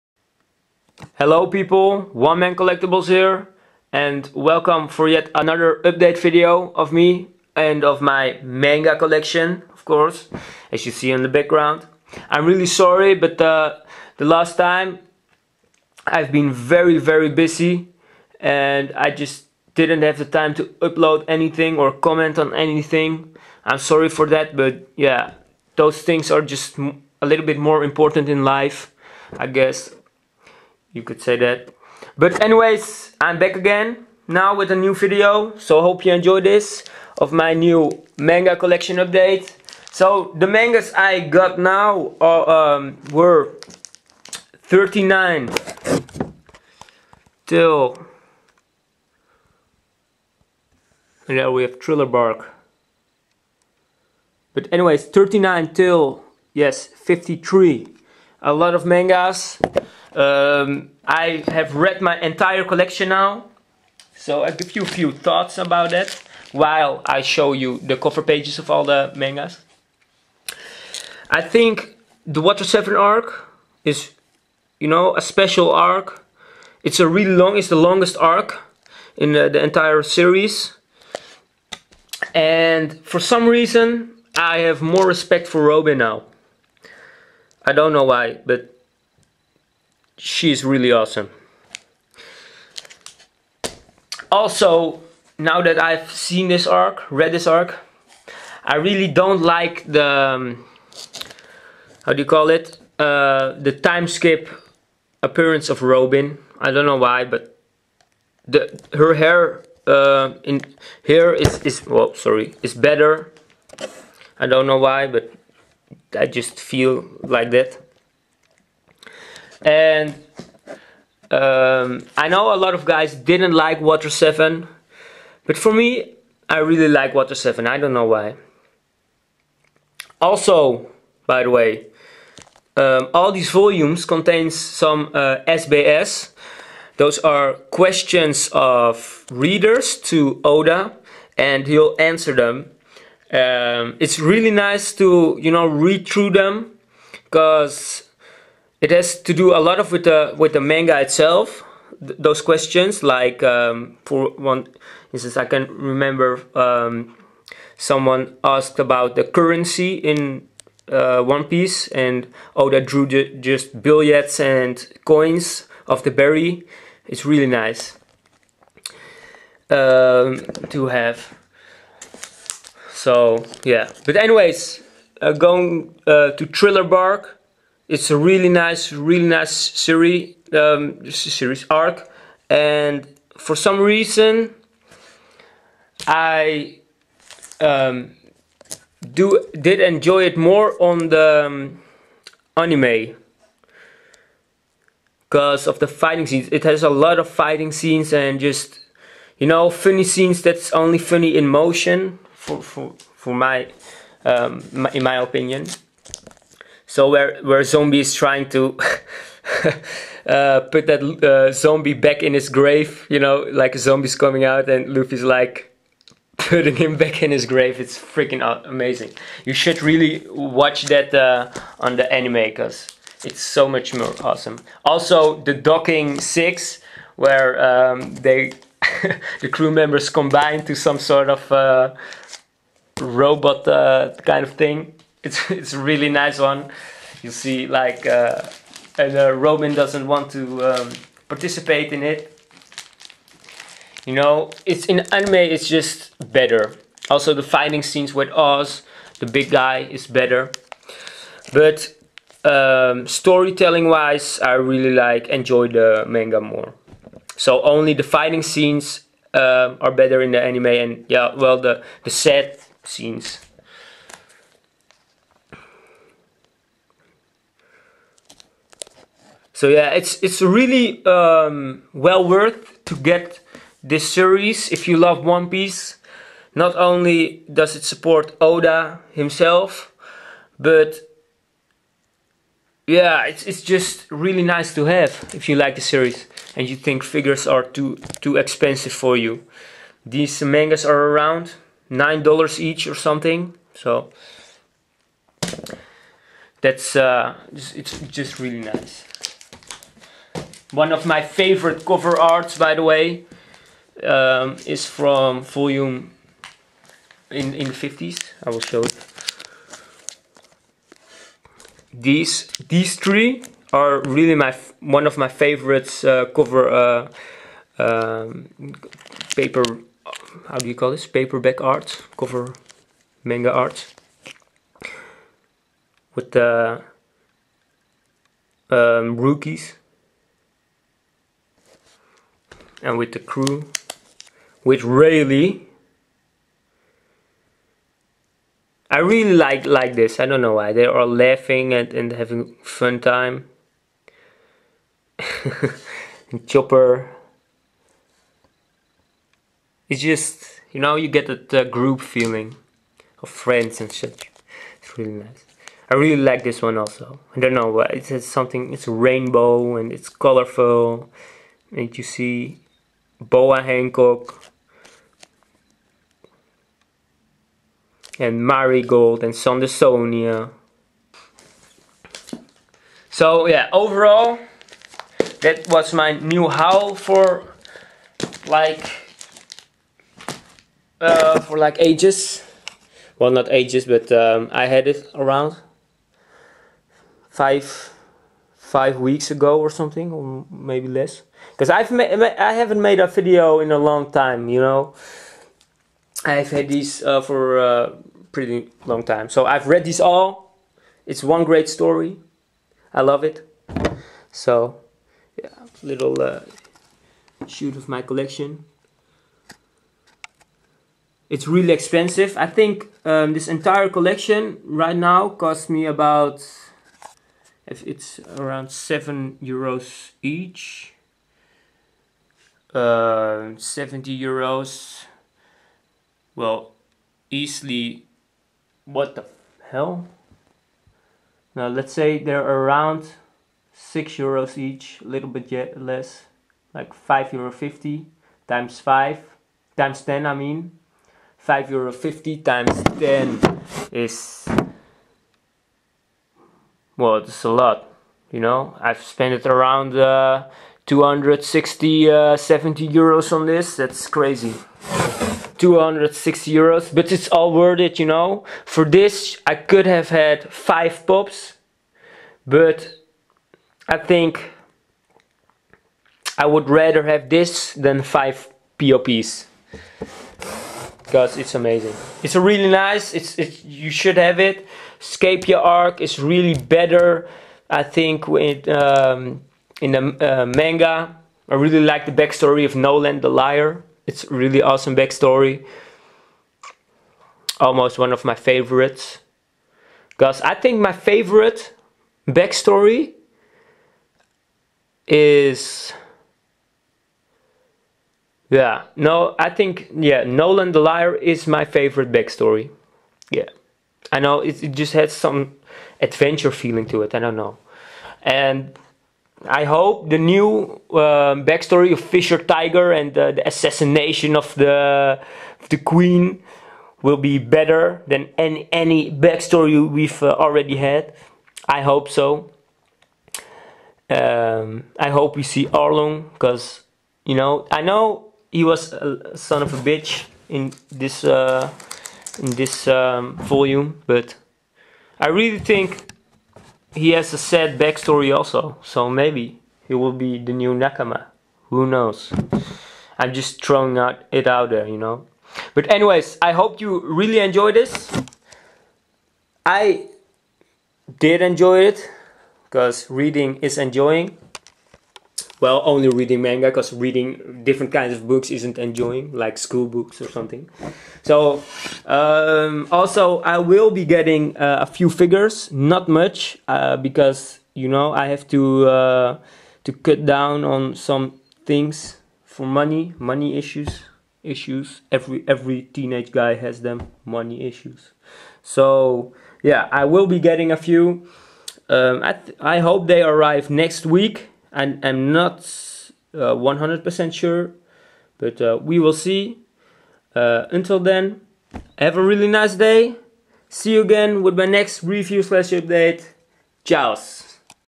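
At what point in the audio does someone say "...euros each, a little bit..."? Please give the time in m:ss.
7:14.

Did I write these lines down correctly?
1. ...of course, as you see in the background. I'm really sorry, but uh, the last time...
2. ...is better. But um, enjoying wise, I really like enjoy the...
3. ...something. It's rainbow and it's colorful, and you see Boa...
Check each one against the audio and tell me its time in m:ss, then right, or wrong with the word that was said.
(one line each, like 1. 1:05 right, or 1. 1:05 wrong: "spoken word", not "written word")
1. 0:09 right
2. 4:09 wrong: "storytelling", not "enjoying"
3. 5:58 right.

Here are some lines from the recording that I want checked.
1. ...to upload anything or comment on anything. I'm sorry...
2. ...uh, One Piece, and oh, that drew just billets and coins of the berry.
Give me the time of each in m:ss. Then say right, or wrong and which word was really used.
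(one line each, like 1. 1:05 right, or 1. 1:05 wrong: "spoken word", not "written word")
1. 0:20 right
2. 2:40 right.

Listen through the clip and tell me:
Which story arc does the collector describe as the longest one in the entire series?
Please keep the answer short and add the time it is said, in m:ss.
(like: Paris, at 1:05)
Water 7, at 1:12.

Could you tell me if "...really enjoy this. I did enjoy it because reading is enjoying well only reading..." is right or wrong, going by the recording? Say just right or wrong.
right.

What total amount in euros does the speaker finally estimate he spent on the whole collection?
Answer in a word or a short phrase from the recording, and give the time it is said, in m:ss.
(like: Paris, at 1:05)
260 euros, at 7:35.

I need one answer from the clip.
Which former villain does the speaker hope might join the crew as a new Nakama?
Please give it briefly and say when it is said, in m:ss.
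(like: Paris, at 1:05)
Arlong, at 8:45.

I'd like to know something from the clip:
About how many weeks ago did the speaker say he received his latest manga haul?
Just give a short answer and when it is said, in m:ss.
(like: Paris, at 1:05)
5 weeks, at 6:27.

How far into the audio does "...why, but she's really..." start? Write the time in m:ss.
1:28.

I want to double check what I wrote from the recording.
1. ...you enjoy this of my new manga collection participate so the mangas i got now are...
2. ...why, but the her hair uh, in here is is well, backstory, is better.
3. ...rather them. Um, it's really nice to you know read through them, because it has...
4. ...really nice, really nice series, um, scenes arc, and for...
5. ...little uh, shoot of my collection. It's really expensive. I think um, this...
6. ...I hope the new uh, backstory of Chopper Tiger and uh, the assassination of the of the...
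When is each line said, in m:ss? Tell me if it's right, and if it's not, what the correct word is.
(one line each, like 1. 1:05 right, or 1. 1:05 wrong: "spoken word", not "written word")
1. 0:36 wrong: "update", not "participate"
2. 1:46 wrong: "sorry", not "backstory"
3. 2:21 wrong: "answer", not "rather"
4. 2:58 wrong: "series", not "scenes"
5. 6:45 right
6. 8:29 wrong: "Fisher", not "Chopper".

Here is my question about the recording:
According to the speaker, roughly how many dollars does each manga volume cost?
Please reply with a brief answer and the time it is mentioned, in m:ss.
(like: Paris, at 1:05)
9 dollars, at 4:51.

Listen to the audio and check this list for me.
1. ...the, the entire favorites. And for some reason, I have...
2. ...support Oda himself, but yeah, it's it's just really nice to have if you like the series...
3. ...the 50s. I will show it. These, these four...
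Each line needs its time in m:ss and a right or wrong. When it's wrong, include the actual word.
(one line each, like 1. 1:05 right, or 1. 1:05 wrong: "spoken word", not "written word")
1. 1:19 wrong: "series", not "favorites"
2. 4:37 right
3. 5:07 wrong: "three", not "four".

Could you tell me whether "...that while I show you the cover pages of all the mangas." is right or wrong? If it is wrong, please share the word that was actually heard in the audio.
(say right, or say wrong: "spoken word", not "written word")
right.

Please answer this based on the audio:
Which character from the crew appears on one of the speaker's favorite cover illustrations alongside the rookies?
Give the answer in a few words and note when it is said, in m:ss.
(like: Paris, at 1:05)
Rayleigh, at 5:34.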